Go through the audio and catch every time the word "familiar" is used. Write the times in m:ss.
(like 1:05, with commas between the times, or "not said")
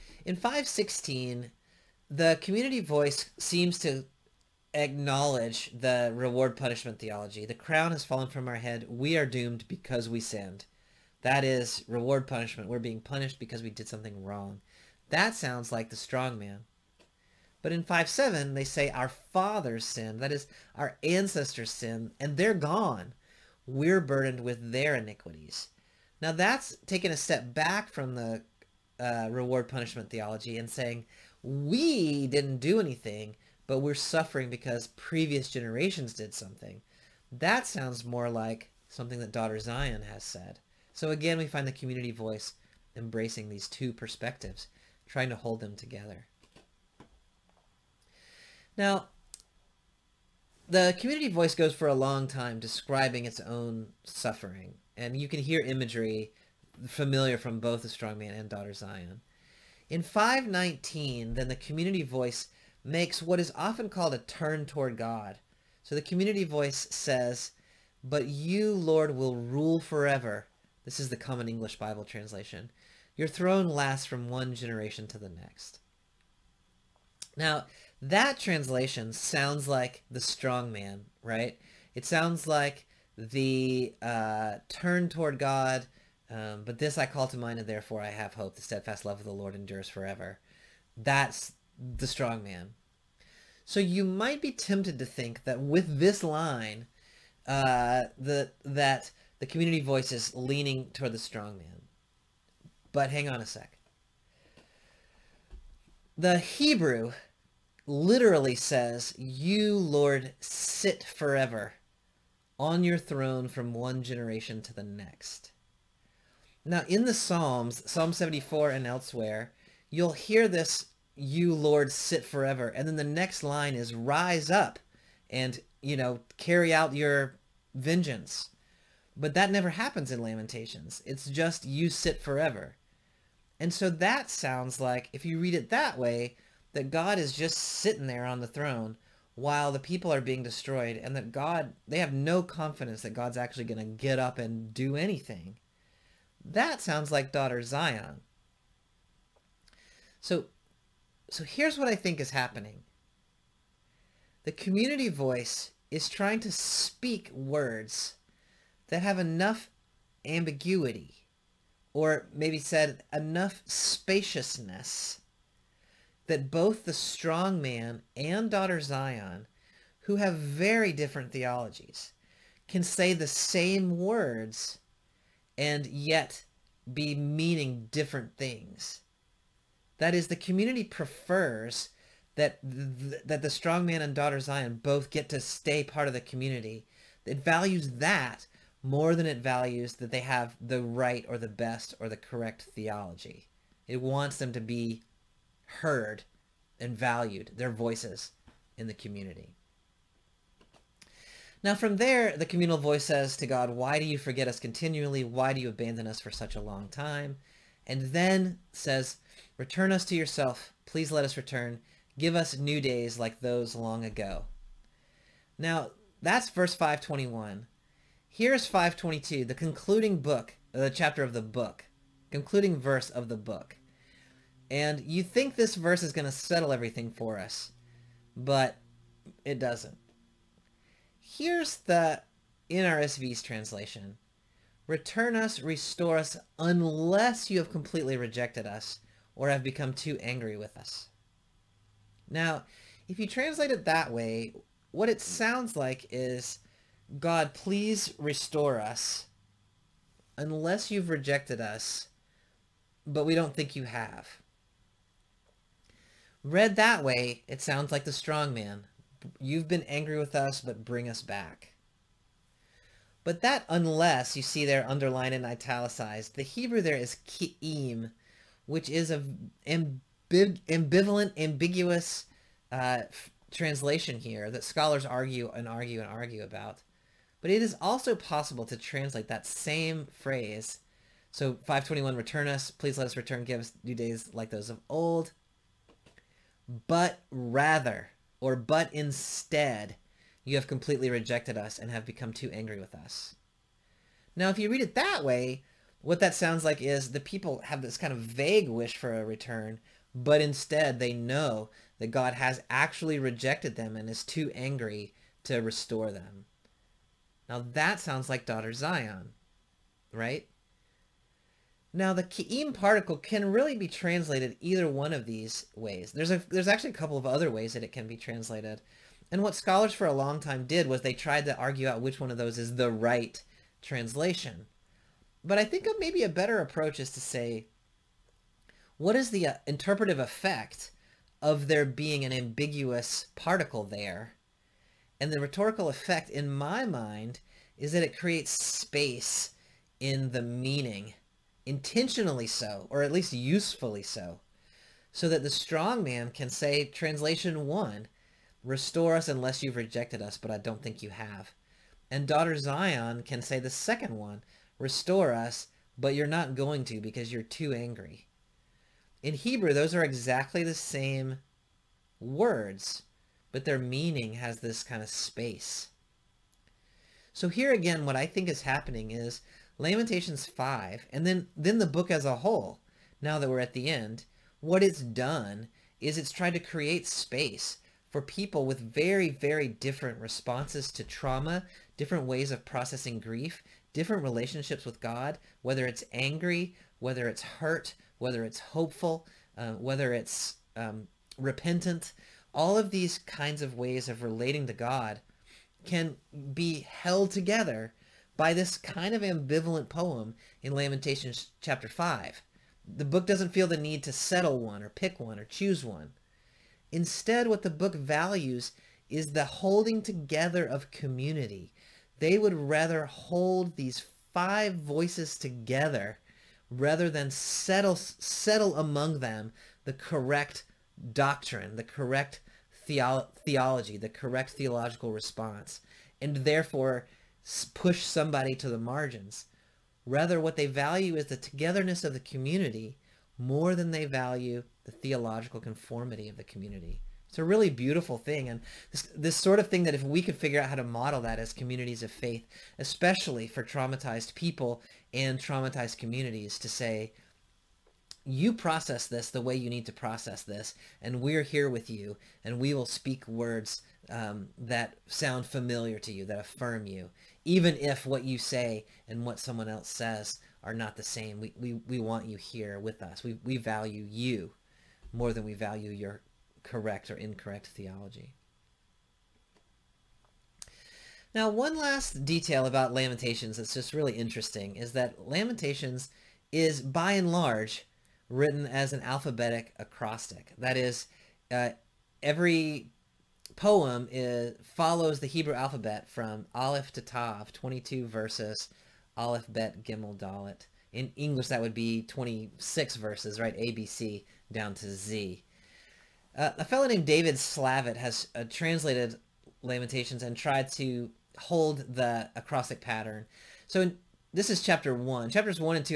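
0:56, 7:35.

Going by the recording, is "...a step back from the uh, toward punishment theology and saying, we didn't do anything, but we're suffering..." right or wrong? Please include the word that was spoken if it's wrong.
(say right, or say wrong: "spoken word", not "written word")
wrong: "reward", not "toward".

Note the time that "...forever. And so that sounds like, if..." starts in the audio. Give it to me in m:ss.
2:12.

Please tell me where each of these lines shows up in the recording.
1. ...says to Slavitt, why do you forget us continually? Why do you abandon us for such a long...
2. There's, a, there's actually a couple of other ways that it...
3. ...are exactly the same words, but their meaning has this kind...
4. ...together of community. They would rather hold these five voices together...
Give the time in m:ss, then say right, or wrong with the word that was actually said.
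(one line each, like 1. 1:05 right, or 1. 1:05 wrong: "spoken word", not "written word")
1. 3:23 wrong: "God", not "Slavitt"
2. 5:16 right
3. 5:59 right
4. 6:50 right.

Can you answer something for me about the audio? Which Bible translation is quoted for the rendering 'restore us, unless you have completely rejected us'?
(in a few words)
NRSV.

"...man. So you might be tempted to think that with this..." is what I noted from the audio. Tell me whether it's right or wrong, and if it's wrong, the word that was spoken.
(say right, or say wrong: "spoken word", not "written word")
right.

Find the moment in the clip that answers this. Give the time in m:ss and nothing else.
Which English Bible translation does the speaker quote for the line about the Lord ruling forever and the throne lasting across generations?
1:11.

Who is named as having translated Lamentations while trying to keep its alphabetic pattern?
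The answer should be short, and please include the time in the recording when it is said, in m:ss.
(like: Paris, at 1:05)
David Slavitt, at 8:17.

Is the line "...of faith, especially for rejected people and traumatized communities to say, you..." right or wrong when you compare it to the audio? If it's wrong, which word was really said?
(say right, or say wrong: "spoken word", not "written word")
wrong: "traumatized", not "rejected".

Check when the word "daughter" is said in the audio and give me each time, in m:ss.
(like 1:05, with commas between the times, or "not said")
0:39, 0:58, 2:27, 2:48, 3:04, 5:08, 5:52.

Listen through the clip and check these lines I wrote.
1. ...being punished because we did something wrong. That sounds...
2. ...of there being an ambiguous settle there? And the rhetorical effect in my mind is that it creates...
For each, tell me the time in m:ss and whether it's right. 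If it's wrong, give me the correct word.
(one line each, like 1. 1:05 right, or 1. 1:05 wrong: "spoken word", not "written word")
1. 0:12 right
2. 5:31 wrong: "particle", not "settle".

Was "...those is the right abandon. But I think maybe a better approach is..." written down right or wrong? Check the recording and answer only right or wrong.
wrong.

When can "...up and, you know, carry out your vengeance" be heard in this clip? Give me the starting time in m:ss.
2:04.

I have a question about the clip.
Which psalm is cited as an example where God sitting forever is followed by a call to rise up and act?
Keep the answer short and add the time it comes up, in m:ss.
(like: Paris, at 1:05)
Psalm 74, at 1:57.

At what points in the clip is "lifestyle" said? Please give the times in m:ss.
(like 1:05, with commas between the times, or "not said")
not said.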